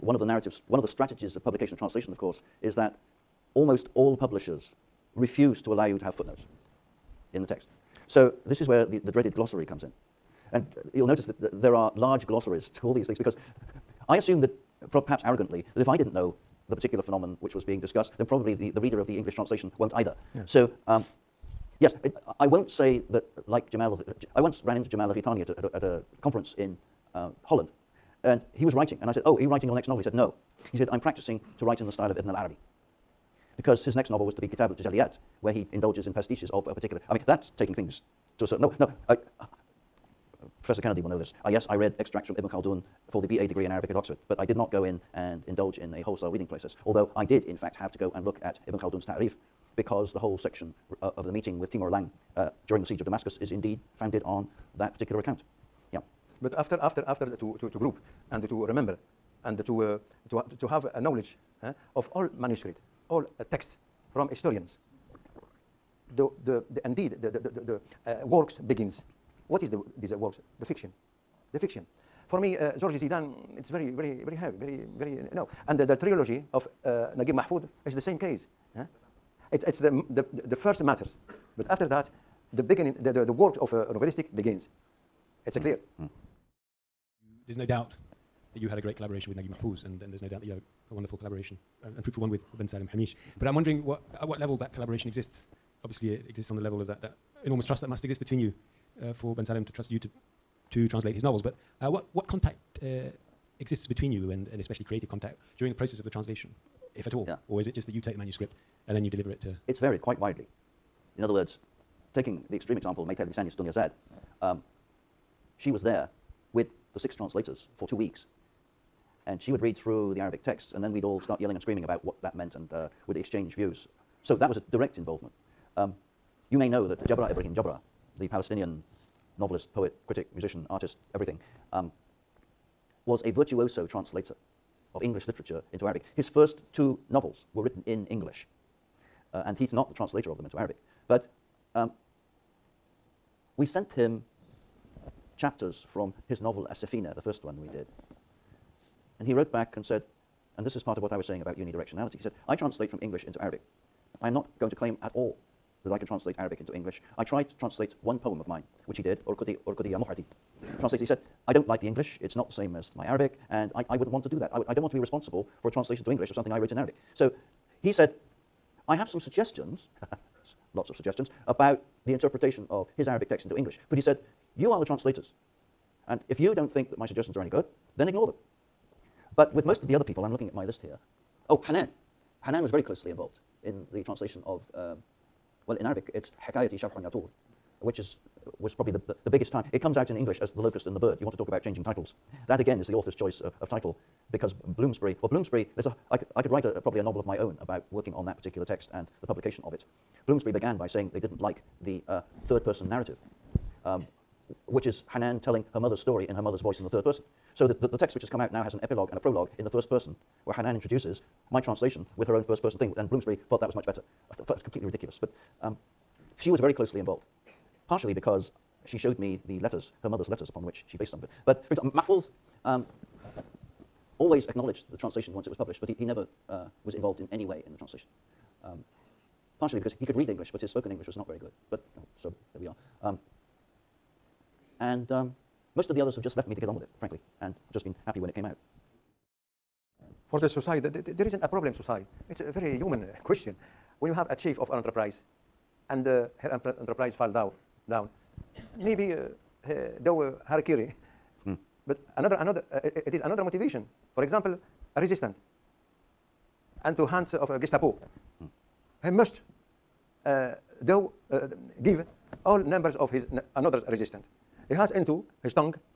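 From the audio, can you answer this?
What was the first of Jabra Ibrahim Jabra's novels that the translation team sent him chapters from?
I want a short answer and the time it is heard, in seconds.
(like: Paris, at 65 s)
Asafina, at 146 s.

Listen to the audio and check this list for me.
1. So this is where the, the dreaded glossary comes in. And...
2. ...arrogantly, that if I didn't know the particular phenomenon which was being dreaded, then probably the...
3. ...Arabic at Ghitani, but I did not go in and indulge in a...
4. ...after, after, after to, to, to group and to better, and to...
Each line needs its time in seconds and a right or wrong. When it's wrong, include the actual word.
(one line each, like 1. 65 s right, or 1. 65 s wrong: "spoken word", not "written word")
1. 8 s right
2. 15 s wrong: "discussed", not "dreaded"
3. 43 s wrong: "Oxford", not "Ghitani"
4. 56 s wrong: "remember", not "better".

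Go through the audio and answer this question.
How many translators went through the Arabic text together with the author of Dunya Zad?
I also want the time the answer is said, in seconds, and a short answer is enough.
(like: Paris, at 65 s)
6, at 116 s.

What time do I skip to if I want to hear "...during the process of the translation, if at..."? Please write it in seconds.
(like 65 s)
105 s.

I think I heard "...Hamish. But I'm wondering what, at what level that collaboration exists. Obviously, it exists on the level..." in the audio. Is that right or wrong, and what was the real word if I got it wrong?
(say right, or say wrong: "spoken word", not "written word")
right.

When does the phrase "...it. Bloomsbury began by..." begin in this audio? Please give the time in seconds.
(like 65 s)
199 s.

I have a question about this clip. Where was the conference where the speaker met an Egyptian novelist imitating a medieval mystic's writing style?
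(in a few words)
Holland.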